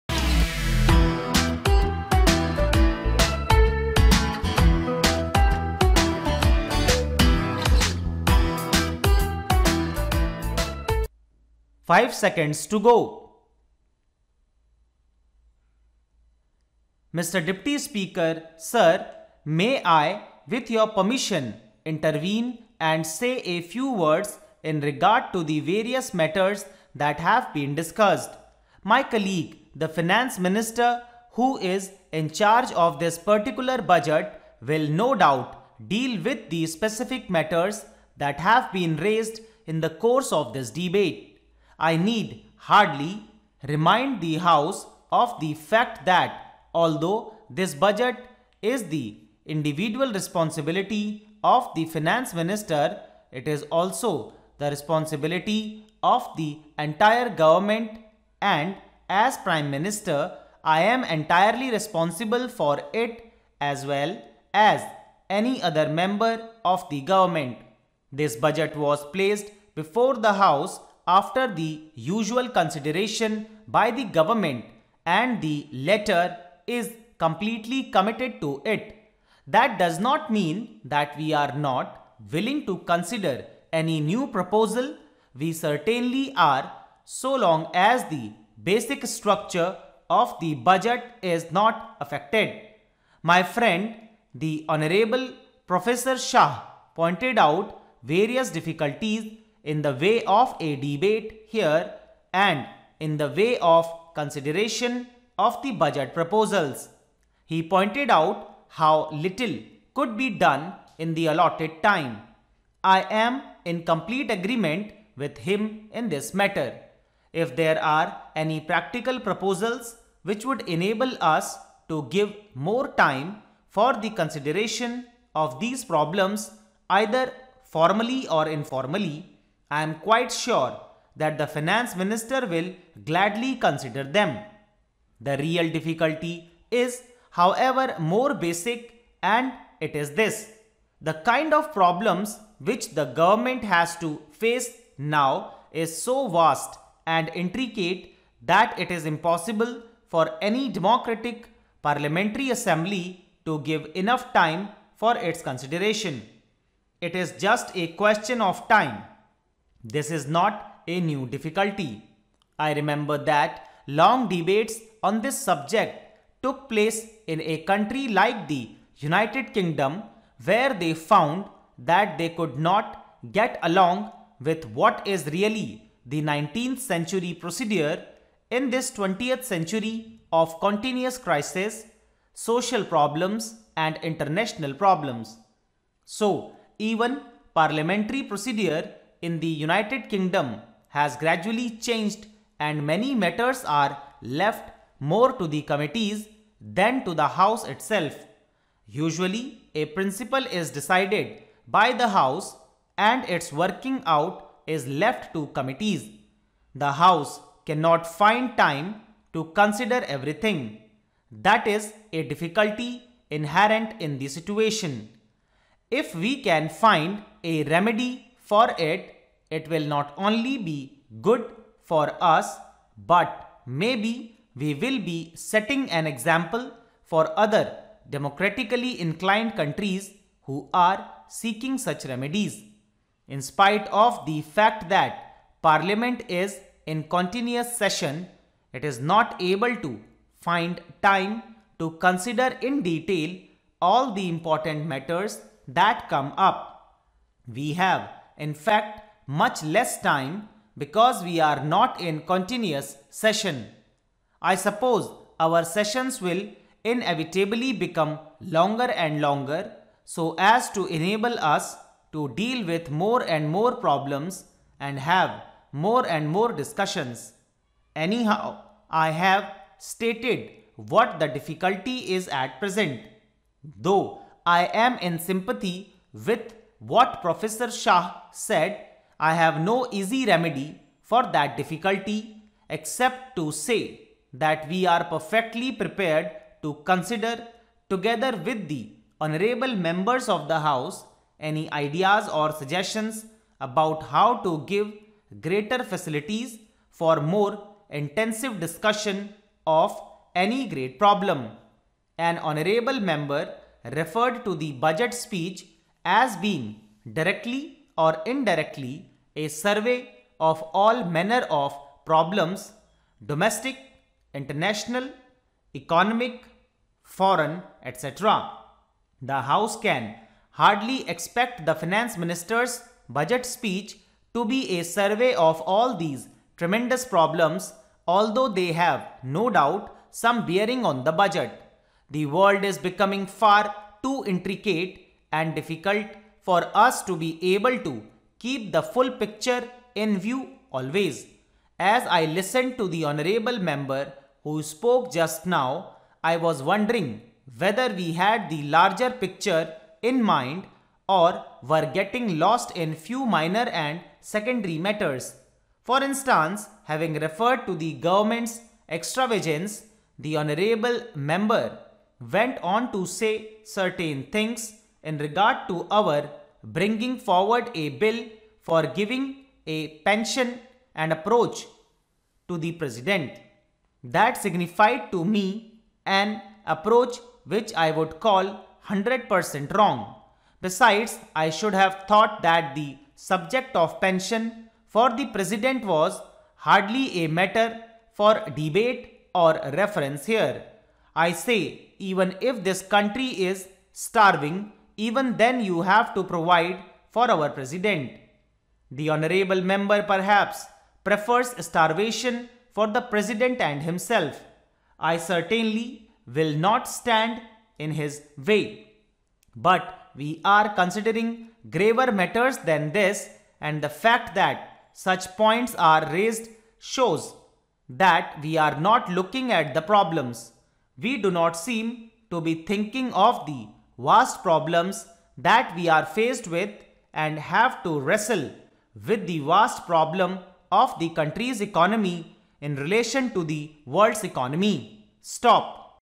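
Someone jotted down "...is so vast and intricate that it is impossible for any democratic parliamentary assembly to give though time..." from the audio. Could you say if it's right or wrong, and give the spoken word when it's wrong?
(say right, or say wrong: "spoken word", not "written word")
wrong: "enough", not "though".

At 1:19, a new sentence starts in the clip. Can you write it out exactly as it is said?
That does not mean that we are not willing to consider any new proposal.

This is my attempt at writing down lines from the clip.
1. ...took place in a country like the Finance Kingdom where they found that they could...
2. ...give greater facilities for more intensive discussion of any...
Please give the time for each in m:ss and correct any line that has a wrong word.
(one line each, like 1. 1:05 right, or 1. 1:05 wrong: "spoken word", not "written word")
1. 2:46 wrong: "United", not "Finance"
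2. 4:54 right.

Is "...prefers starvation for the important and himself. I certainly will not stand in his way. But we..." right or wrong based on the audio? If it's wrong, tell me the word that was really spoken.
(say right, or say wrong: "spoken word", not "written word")
wrong: "president", not "important".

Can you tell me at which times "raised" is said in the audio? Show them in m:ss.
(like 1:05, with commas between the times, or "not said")
0:38, 6:56.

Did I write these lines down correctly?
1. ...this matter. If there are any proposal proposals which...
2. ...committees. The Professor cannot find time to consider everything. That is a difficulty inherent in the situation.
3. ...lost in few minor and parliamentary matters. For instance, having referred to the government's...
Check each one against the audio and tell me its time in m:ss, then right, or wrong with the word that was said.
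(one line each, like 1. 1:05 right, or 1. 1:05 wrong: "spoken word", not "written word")
1. 1:56 wrong: "practical", not "proposal"
2. 3:25 wrong: "House", not "Professor"
3. 5:52 wrong: "secondary", not "parliamentary".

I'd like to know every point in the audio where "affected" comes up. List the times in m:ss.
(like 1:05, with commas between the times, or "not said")
1:31.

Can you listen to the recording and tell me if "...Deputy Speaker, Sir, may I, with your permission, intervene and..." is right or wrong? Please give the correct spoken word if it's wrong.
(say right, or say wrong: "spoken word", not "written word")
right.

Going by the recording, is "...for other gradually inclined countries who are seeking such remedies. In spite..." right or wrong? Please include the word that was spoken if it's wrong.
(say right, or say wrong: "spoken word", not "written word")
wrong: "democratically", not "gradually".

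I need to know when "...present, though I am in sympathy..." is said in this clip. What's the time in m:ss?
4:32.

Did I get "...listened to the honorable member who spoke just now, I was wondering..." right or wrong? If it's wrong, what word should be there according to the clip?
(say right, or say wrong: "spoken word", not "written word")
right.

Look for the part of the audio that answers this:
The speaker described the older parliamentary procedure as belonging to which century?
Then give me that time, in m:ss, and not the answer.
2:56.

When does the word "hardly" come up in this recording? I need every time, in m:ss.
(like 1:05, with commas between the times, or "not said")
0:42, 5:20, 6:26.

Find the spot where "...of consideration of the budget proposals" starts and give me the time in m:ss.
1:43.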